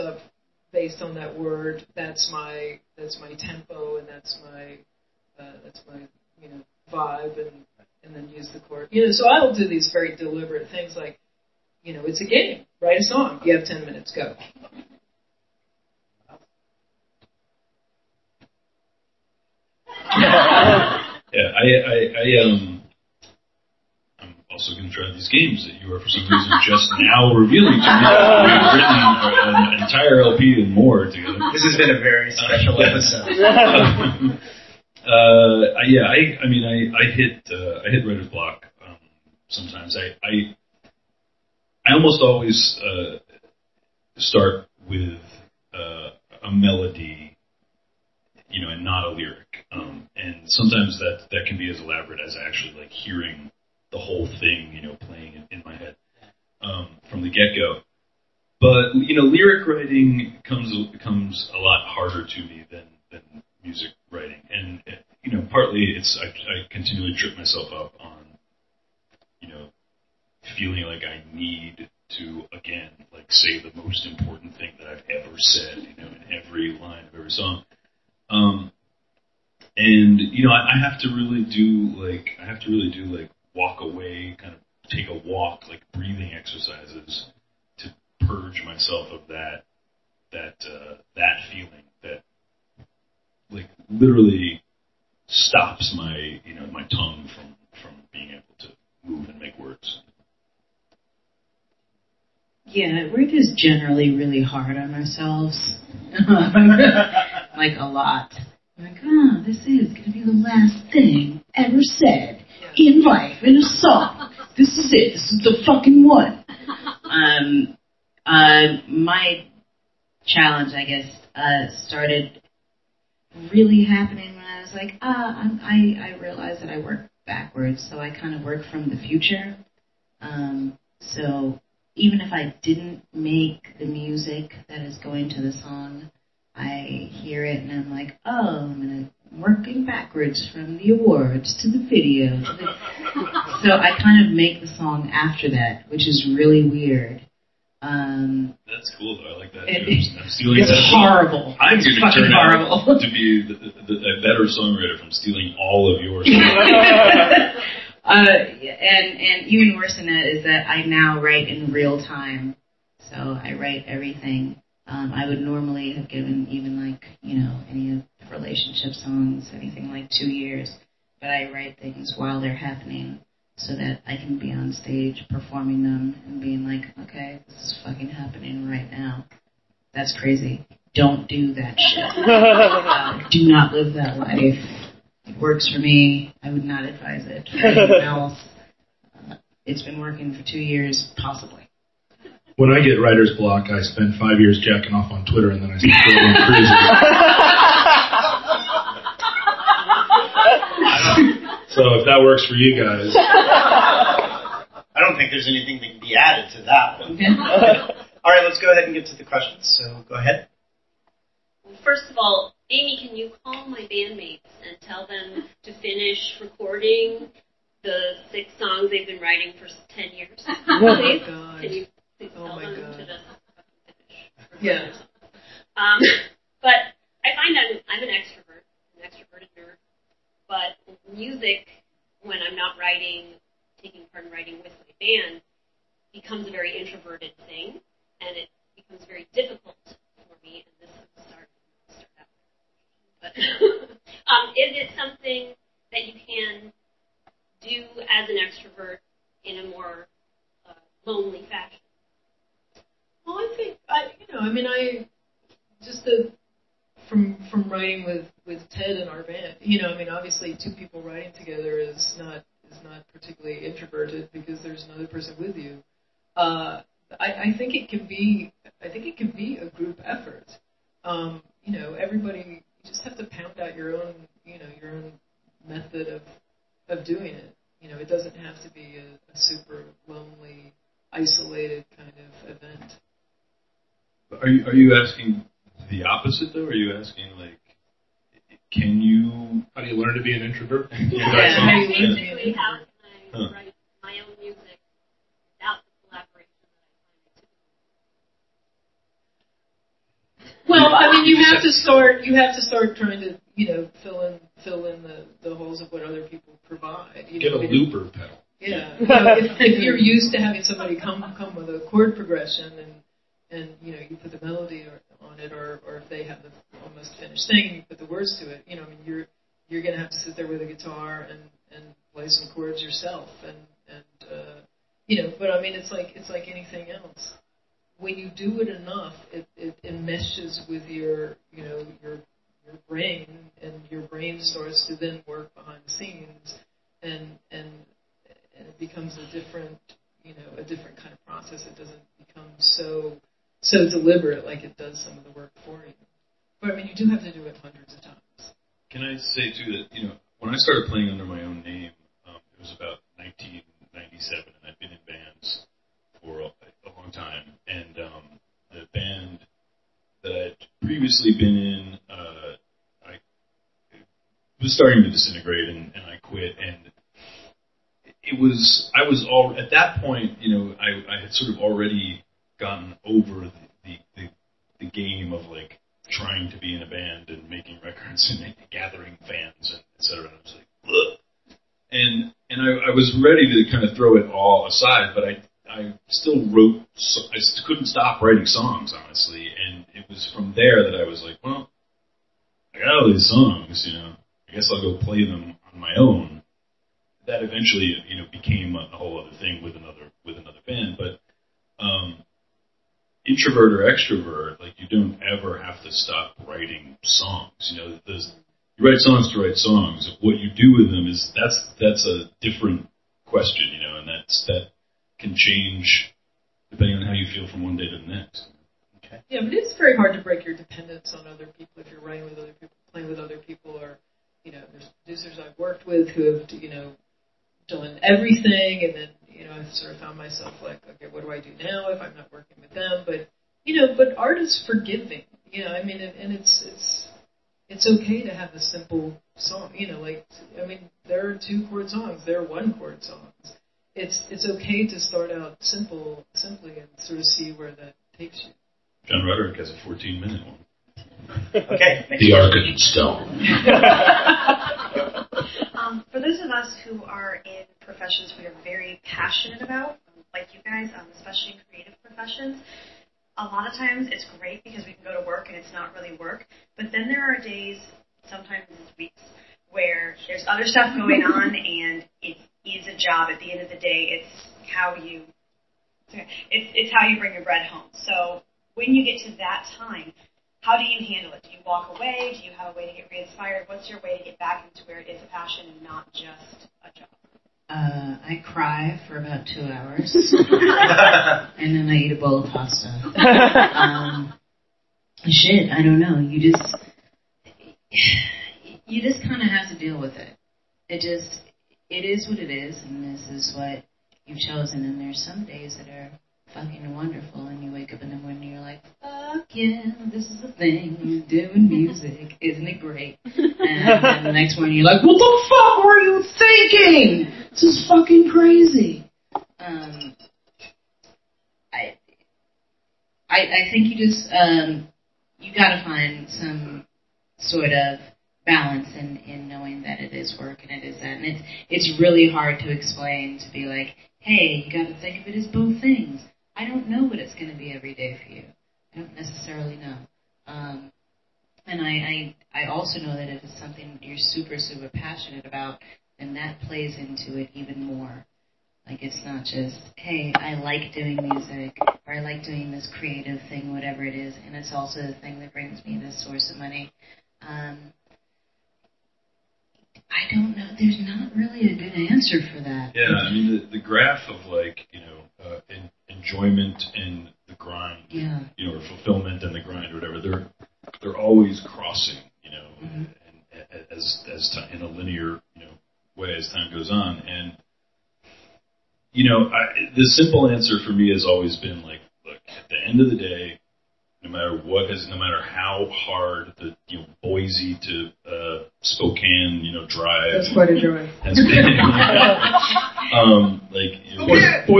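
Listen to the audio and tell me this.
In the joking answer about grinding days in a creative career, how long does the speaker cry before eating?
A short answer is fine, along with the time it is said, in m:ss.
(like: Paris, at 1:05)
2 hours, at 8:09.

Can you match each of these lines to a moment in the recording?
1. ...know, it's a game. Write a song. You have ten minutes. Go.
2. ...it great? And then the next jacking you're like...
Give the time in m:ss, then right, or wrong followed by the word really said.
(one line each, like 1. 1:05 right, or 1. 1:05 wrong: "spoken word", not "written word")
1. 0:11 right
2. 8:32 wrong: "morning", not "jacking".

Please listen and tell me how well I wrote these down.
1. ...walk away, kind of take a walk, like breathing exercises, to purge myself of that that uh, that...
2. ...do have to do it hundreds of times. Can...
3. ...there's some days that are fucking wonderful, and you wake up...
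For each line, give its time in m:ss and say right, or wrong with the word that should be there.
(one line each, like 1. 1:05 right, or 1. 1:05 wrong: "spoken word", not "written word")
1. 1:23 right
2. 5:46 right
3. 8:24 right.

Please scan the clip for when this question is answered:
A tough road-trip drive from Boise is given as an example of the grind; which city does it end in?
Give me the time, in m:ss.
9:48.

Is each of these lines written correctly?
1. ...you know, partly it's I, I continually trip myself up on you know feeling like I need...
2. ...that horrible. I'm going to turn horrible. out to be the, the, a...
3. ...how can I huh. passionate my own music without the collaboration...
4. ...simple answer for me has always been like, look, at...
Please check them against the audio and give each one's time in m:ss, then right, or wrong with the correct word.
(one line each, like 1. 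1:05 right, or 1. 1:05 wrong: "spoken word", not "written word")
1. 1:05 right
2. 2:30 right
3. 4:52 wrong: "write", not "passionate"
4. 9:40 right.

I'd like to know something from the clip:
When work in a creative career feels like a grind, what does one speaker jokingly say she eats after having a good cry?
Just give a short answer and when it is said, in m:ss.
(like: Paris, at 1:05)
a bowl of pasta, at 8:12.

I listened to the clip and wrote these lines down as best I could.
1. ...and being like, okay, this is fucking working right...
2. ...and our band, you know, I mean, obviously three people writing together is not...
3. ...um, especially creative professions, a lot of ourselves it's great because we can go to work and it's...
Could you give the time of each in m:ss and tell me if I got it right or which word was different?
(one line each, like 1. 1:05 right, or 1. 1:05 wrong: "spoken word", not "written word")
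1. 2:56 wrong: "happening", not "working"
2. 4:18 wrong: "two", not "three"
3. 7:40 wrong: "times", not "ourselves".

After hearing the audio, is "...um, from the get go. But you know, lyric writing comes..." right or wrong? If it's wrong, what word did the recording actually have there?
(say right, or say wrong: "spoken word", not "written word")
right.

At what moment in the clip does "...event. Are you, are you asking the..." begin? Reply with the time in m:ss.
4:42.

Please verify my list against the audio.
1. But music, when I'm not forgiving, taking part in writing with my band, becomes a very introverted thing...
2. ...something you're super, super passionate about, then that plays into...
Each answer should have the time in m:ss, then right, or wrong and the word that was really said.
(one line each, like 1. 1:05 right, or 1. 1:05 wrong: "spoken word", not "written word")
1. 3:50 wrong: "writing", not "forgiving"
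2. 9:03 right.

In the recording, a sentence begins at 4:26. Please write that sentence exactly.
Uh, I, I think it can be I think it can be a group effort.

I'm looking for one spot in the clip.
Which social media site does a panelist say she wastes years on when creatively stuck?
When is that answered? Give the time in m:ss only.
3:15.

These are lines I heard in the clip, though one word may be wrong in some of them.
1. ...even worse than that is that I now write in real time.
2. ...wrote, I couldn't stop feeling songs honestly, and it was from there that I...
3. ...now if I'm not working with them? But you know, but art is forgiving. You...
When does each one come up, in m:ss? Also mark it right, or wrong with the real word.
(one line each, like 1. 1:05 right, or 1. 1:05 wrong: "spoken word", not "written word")
1. 2:39 right
2. 6:26 wrong: "writing", not "feeling"
3. 7:11 right.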